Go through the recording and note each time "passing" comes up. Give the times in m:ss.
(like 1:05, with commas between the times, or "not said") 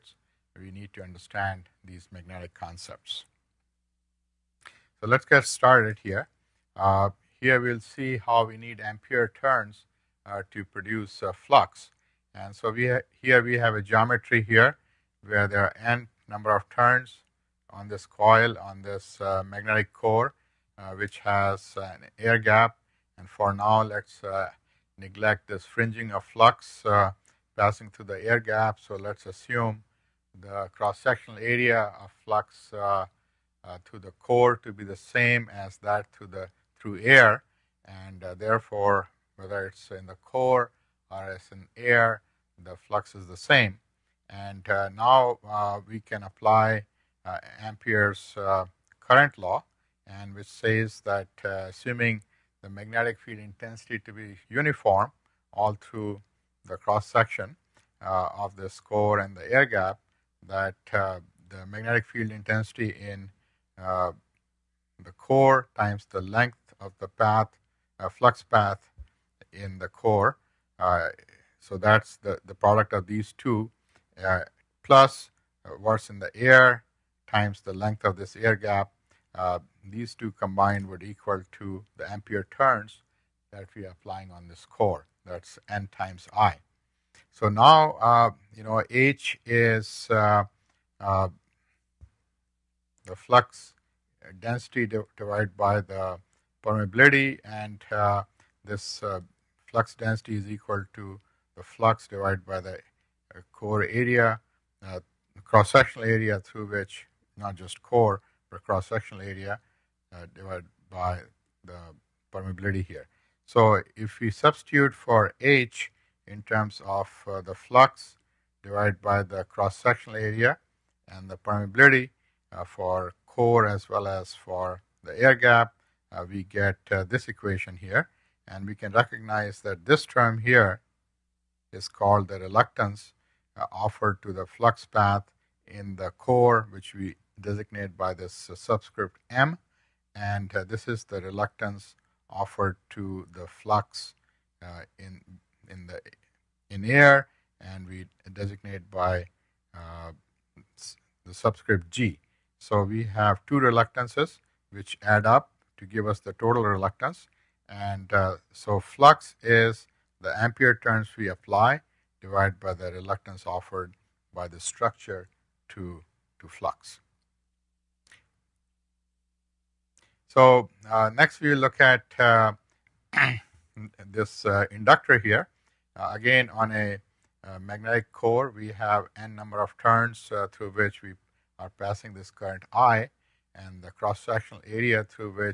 0:27, 3:01.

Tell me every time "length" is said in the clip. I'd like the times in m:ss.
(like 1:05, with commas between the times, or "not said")
1:06, 1:17.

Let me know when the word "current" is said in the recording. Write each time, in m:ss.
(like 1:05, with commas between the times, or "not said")
0:49, 3:02.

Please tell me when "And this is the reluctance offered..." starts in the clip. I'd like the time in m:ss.
2:20.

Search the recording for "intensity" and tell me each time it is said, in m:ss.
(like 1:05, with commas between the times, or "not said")
0:53, 1:02.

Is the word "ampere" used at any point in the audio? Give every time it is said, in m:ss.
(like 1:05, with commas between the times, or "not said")
0:08, 0:47, 1:22, 2:40.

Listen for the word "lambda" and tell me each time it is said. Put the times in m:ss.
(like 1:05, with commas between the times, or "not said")
not said.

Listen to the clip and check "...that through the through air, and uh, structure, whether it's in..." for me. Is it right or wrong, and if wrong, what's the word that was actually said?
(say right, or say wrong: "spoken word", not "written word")
wrong: "therefore", not "structure".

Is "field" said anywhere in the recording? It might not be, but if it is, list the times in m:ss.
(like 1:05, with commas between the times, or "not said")
0:53, 1:02.